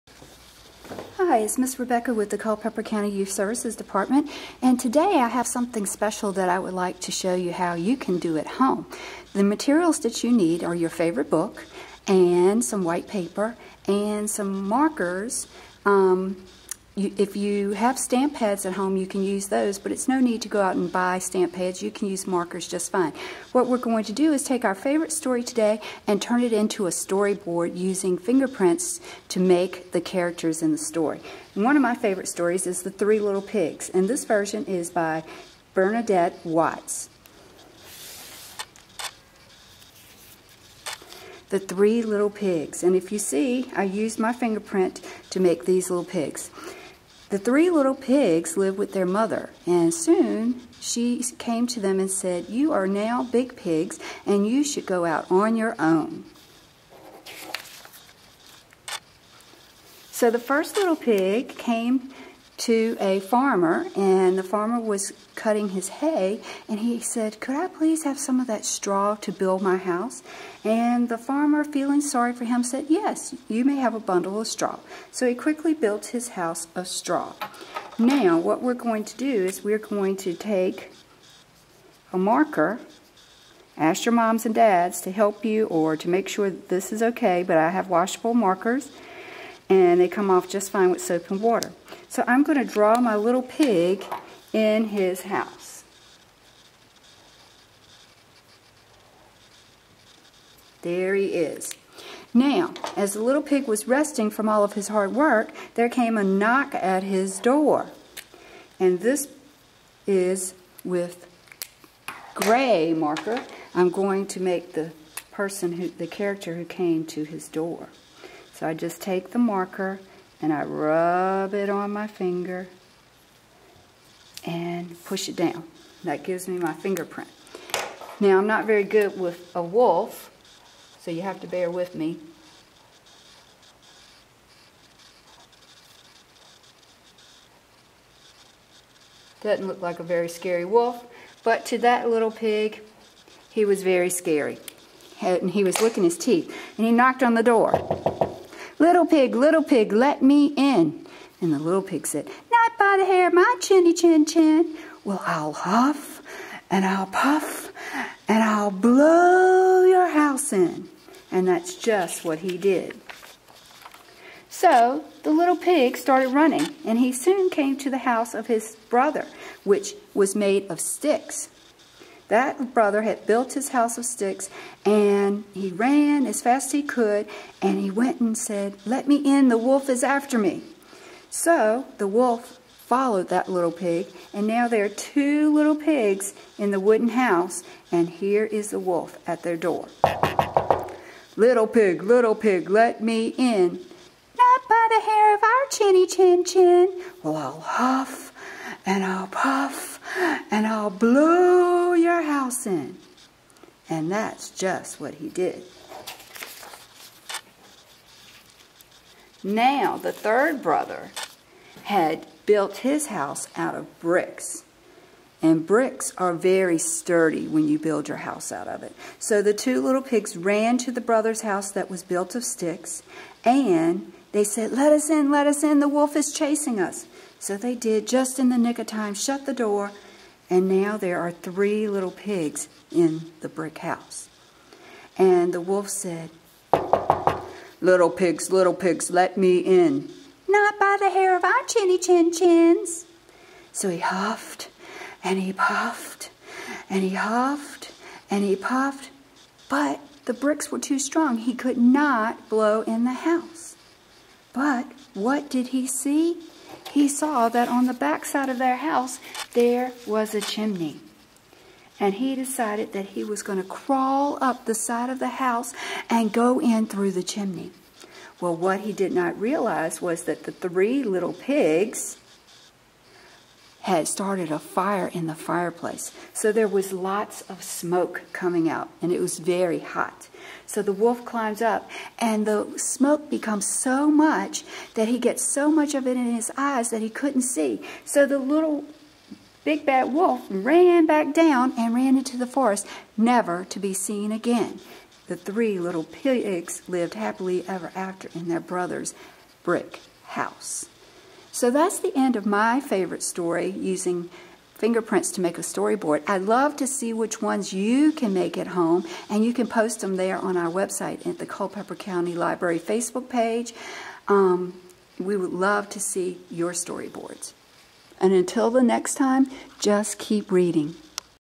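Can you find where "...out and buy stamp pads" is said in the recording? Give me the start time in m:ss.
0:20.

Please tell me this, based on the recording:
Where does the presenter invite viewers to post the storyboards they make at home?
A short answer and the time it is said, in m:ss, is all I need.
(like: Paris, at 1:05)
Culpeper County Library Facebook page, at 5:11.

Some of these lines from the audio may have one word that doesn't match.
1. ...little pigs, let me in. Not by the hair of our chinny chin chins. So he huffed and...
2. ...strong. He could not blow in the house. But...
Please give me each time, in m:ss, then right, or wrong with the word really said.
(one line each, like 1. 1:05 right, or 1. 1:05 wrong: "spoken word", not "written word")
1. 3:58 right
2. 4:10 right.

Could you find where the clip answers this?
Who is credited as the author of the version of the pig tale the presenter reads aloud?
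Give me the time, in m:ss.
0:35.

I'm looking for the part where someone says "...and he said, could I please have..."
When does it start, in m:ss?
1:06.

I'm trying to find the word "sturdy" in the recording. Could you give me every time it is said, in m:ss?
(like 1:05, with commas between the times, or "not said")
3:36.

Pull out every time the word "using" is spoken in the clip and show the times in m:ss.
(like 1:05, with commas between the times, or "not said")
0:27, 5:03.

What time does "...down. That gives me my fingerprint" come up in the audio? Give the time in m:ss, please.
2:05.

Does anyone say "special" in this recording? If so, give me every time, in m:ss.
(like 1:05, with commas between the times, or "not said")
0:05.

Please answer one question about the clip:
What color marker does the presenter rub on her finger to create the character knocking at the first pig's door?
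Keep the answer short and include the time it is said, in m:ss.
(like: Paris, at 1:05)
Gray, at 1:52.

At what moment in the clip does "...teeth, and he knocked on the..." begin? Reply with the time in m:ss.
2:26.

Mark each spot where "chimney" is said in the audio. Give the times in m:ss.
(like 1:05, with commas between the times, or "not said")
4:20, 4:27.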